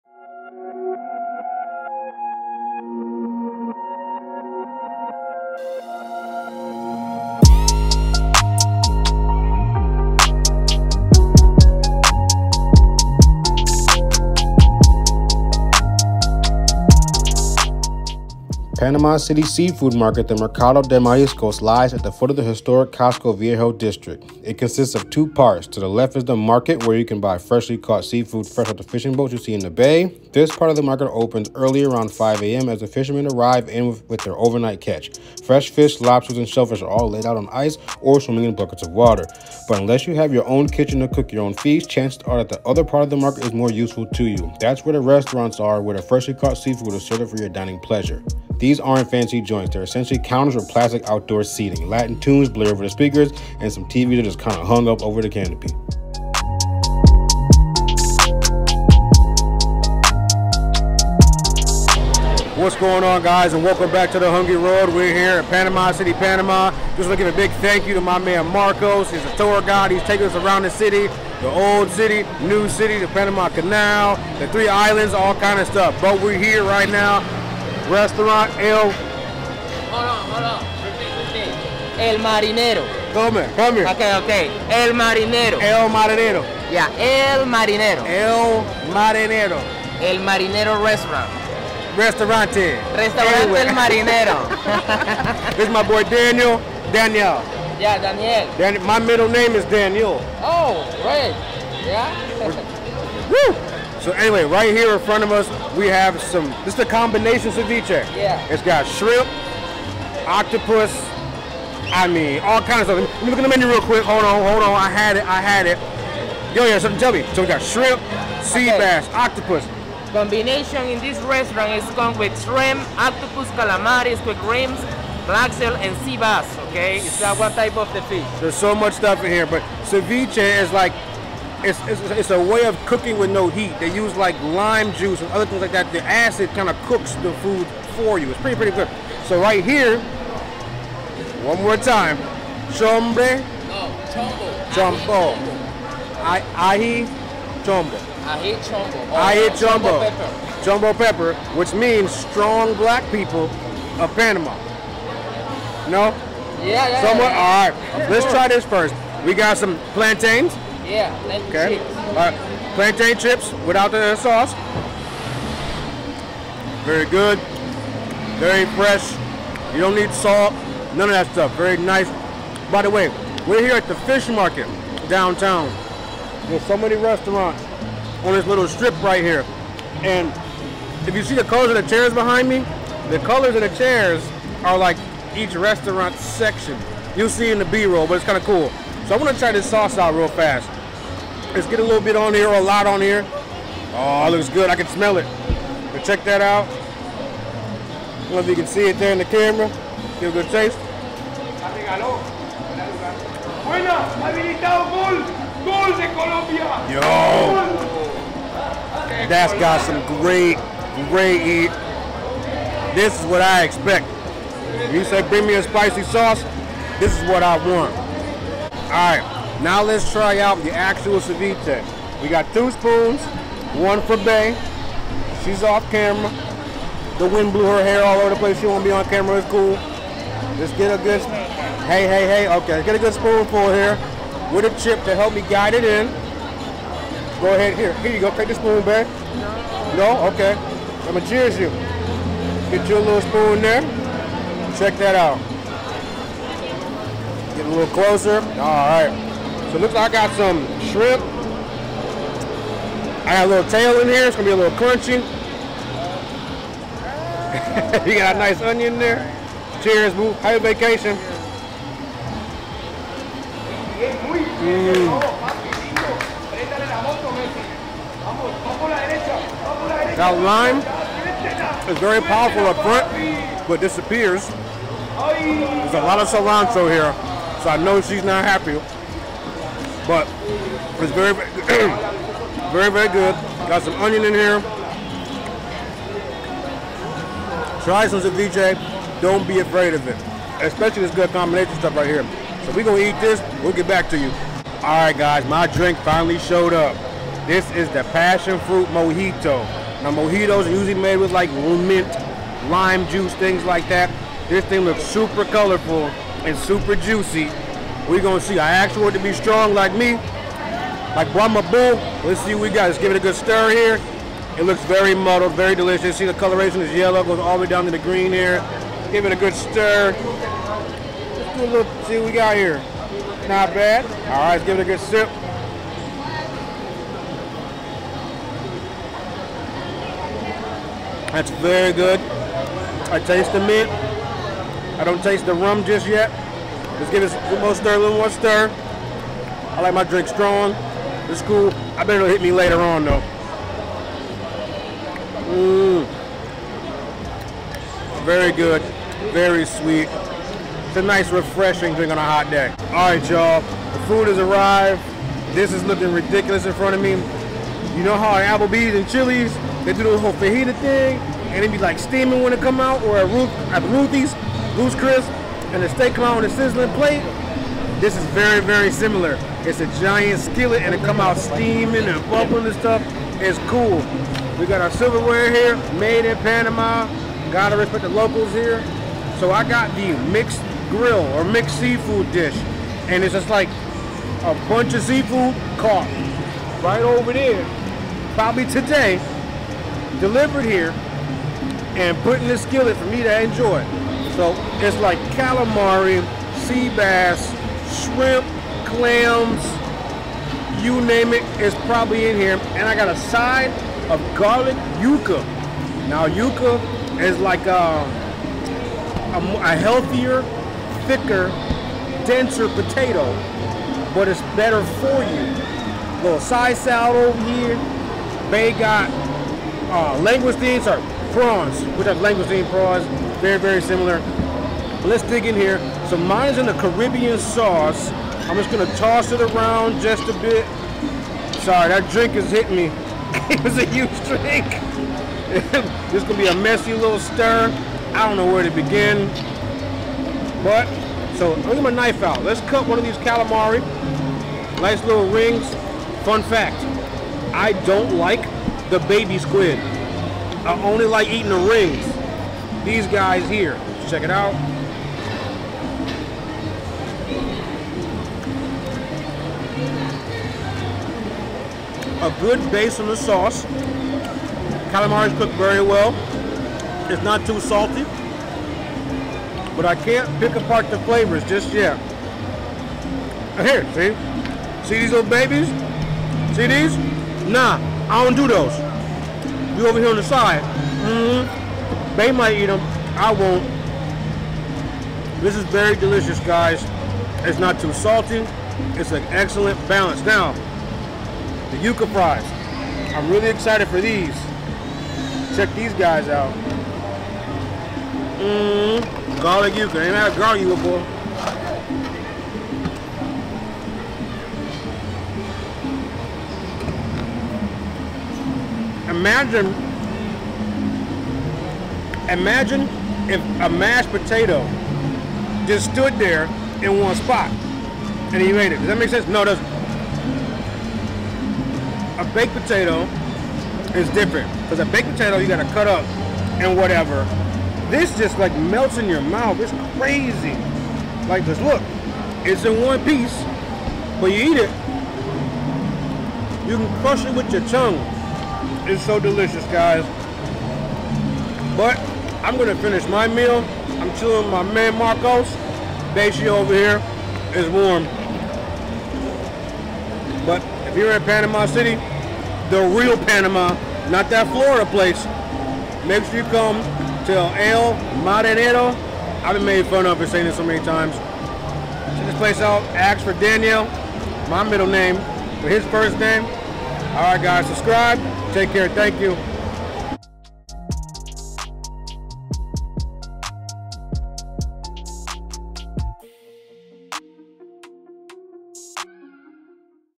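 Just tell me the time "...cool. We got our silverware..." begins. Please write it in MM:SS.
06:13.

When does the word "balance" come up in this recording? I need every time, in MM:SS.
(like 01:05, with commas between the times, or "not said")
08:09.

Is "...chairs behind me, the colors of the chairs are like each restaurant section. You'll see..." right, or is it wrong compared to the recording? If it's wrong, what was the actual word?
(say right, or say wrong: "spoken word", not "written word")
right.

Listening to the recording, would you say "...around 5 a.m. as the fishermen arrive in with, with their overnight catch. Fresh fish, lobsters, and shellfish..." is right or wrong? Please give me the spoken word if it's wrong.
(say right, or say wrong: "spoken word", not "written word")
right.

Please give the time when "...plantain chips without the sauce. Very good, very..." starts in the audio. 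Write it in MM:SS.
02:42.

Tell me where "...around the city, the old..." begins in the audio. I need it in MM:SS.
01:10.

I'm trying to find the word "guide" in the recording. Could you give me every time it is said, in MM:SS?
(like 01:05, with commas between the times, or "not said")
01:09, 03:55.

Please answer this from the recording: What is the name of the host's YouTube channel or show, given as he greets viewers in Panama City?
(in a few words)
The Hungry Road.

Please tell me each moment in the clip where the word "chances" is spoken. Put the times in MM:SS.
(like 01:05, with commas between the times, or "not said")
00:41.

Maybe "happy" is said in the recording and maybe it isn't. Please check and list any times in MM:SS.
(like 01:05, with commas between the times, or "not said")
04:20, 04:38.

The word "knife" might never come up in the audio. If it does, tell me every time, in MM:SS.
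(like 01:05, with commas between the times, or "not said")
07:21.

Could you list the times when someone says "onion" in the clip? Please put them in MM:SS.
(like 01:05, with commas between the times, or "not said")
04:18, 04:44.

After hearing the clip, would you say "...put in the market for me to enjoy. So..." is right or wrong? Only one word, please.
wrong.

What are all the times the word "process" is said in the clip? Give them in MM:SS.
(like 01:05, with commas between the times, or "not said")
not said.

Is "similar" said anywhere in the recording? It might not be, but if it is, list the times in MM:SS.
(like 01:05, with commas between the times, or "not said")
06:08, 07:03.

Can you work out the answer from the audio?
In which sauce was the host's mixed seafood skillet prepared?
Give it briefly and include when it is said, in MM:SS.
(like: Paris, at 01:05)
Caribbean sauce, at 07:06.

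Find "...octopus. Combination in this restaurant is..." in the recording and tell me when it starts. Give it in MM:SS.
01:59.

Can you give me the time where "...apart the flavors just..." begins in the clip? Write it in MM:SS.
07:50.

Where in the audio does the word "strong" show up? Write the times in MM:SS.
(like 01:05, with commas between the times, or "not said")
02:32, 05:09, 05:40.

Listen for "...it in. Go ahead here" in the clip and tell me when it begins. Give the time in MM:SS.
03:55.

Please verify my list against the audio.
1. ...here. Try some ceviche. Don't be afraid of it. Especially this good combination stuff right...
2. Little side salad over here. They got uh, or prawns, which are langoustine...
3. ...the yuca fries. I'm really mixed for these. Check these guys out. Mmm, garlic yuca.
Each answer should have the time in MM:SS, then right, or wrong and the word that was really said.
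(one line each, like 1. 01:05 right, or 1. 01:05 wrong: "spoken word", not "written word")
1. 04:44 right
2. 06:56 right
3. 08:11 wrong: "excited", not "mixed".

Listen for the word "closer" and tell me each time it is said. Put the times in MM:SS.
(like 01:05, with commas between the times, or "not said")
04:07.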